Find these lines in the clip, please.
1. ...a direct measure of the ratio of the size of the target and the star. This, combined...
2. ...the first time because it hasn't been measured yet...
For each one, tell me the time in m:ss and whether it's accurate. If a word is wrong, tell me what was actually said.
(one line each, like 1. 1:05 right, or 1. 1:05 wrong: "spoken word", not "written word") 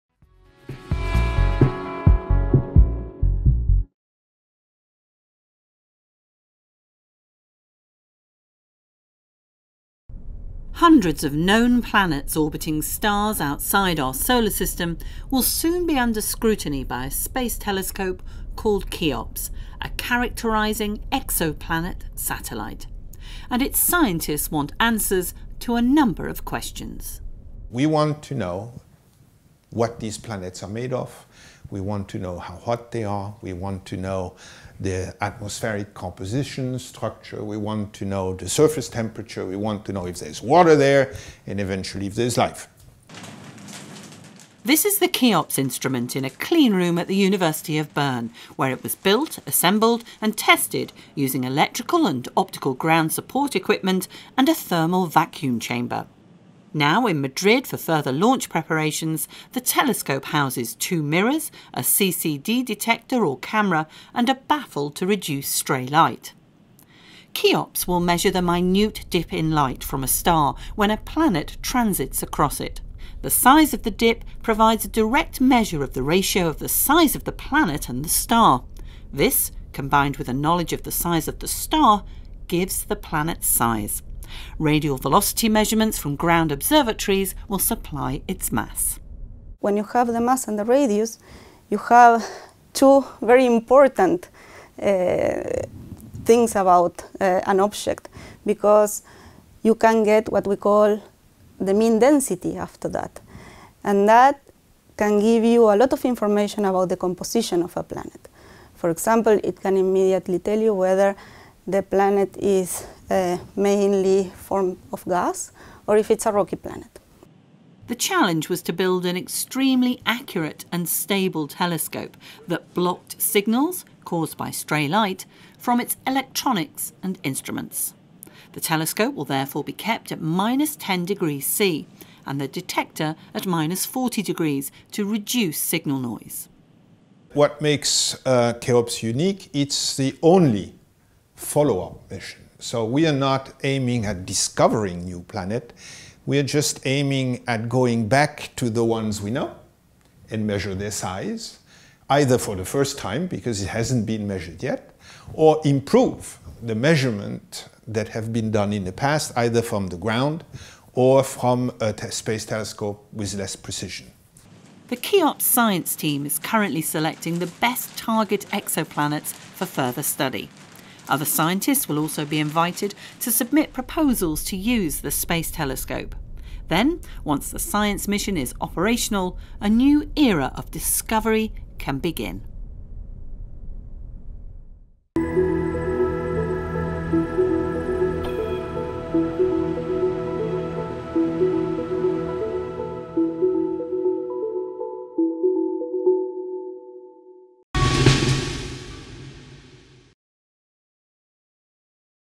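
1. 1:14 wrong: "planet", not "target"
2. 2:32 right.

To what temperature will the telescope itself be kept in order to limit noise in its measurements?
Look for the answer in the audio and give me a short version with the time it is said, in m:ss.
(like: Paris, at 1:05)
-10 degrees C, at 2:10.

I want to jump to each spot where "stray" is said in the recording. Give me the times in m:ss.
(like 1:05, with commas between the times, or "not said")
1:05, 2:04.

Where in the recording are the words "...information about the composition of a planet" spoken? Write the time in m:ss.
1:46.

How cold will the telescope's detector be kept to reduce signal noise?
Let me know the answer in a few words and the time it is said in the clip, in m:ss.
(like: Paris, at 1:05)
-40 degrees, at 2:13.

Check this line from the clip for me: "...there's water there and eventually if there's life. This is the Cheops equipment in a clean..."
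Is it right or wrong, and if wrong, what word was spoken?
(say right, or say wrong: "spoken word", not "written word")
wrong: "instrument", not "equipment".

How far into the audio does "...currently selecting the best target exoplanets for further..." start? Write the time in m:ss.
2:46.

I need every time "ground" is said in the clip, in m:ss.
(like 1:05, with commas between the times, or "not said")
0:52, 1:26, 2:39.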